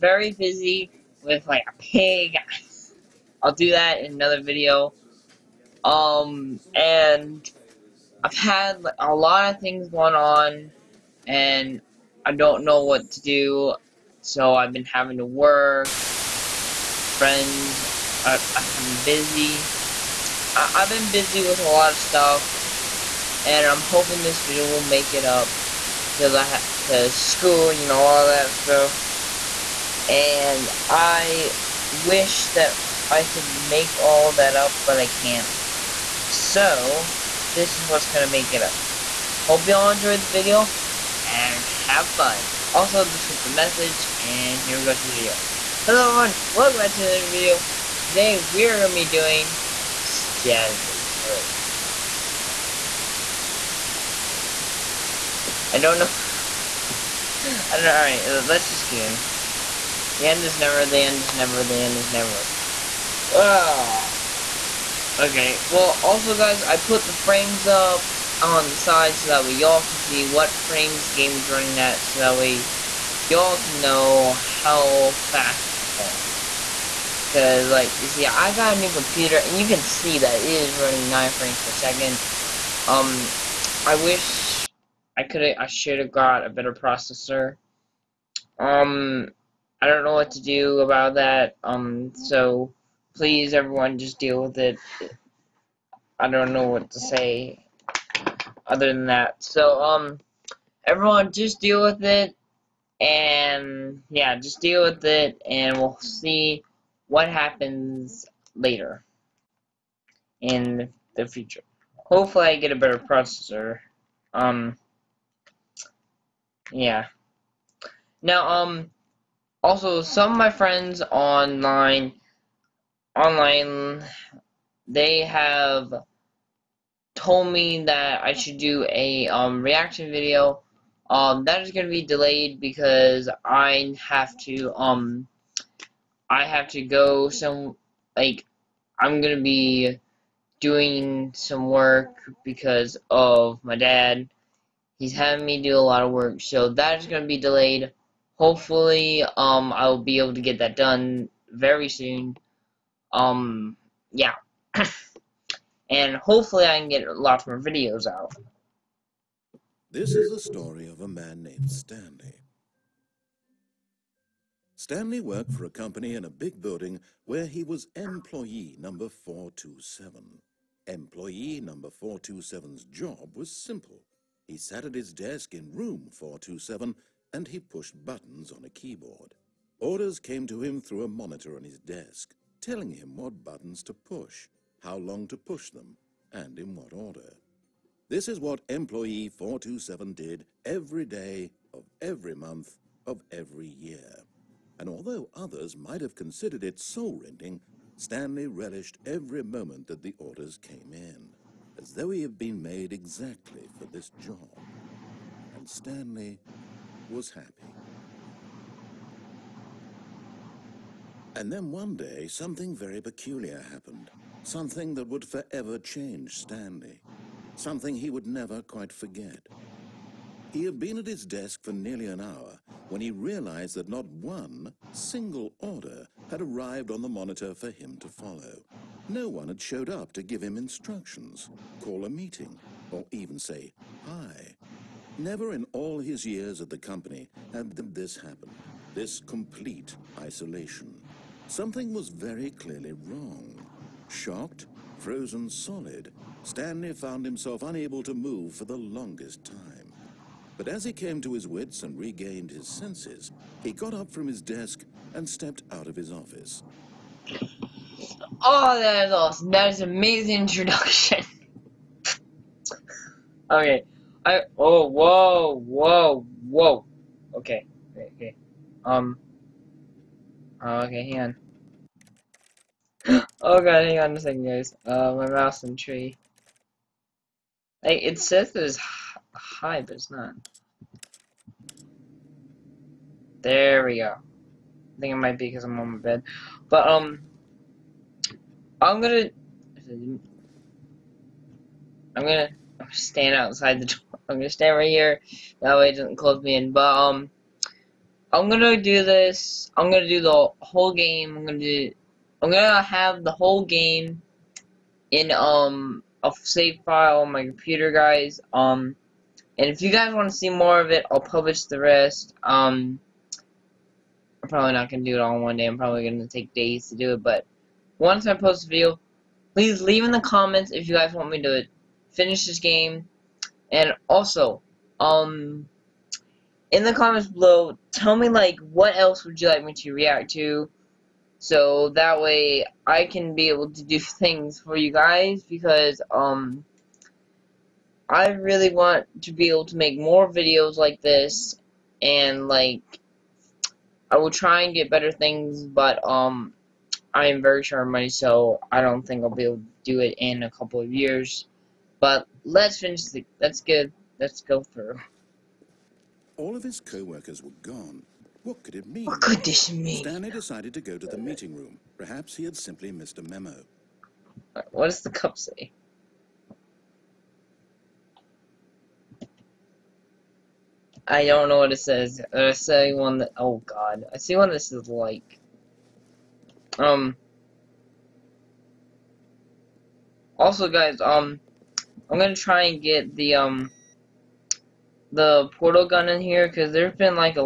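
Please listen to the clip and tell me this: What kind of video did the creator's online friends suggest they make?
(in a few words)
reaction video.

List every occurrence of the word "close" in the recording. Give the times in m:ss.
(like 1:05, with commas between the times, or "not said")
4:56.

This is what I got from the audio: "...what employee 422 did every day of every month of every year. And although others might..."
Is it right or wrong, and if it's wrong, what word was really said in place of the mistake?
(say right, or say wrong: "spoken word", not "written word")
wrong: "427", not "422".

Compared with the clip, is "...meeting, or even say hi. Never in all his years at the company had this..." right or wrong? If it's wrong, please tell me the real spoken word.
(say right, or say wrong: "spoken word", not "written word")
right.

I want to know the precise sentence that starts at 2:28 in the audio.
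Hopefully, um, I will be able to get that done very soon.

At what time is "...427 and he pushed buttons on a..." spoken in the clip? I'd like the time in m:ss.
2:56.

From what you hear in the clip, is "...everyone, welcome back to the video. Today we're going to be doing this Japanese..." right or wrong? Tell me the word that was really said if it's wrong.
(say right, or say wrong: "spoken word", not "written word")
right.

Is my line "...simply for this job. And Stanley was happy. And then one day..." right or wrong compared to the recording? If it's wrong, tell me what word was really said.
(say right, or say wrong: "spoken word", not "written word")
wrong: "exactly", not "simply".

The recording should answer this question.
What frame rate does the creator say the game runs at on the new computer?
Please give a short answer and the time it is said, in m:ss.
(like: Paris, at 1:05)
9 frames per second, at 1:21.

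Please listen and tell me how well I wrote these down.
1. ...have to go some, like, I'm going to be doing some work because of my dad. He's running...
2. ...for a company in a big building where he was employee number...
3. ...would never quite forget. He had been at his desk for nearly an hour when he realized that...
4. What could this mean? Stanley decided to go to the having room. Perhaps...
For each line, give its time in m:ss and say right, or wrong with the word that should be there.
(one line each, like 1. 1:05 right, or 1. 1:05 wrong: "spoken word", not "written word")
1. 2:16 wrong: "having", not "running"
2. 2:45 right
3. 3:38 right
4. 5:59 wrong: "meeting", not "having".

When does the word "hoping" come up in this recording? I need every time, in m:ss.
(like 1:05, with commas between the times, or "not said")
0:23.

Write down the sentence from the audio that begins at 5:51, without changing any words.
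But let's finish the let let's go through.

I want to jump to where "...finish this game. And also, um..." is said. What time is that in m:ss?
5:22.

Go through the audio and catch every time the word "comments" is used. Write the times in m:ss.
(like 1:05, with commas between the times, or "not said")
5:20, 5:26.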